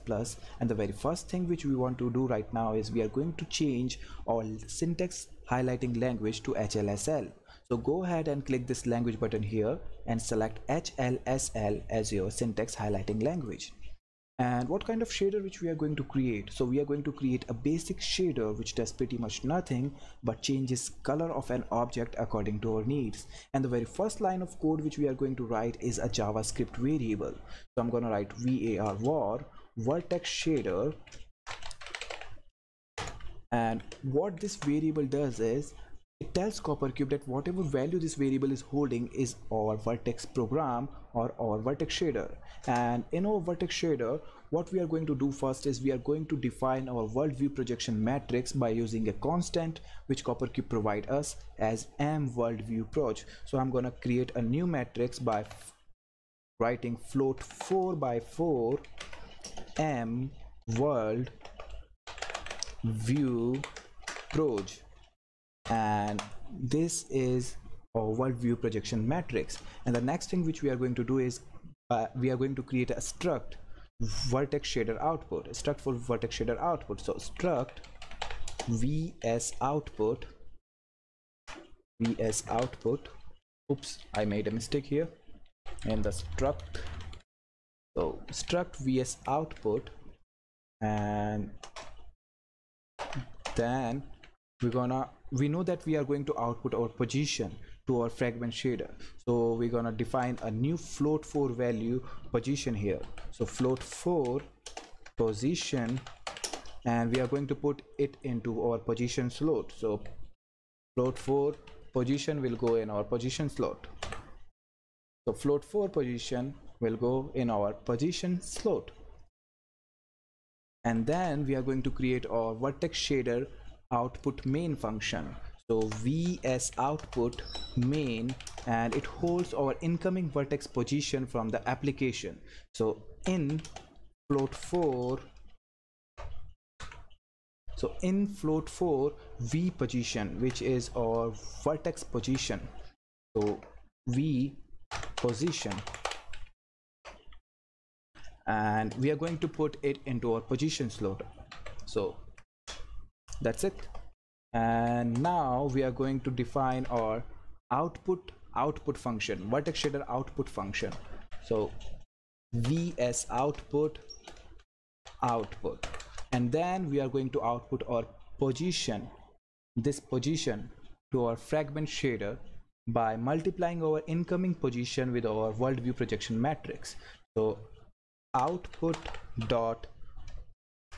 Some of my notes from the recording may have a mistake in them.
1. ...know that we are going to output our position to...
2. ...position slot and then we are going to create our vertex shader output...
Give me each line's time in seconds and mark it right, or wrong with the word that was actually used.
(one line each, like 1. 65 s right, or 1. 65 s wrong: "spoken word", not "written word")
1. 95 s right
2. 117 s right.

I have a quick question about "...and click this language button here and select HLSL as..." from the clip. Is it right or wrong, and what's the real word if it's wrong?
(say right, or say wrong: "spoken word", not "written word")
right.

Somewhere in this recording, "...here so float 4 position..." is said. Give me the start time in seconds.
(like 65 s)
102 s.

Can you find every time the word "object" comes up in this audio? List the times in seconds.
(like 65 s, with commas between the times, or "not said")
21 s.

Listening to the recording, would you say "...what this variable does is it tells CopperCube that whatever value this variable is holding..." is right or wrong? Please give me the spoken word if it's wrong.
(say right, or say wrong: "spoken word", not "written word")
right.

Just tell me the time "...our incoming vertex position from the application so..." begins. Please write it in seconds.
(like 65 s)
129 s.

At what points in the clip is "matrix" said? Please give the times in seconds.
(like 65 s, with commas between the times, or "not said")
48 s, 54 s, 69 s, 176 s.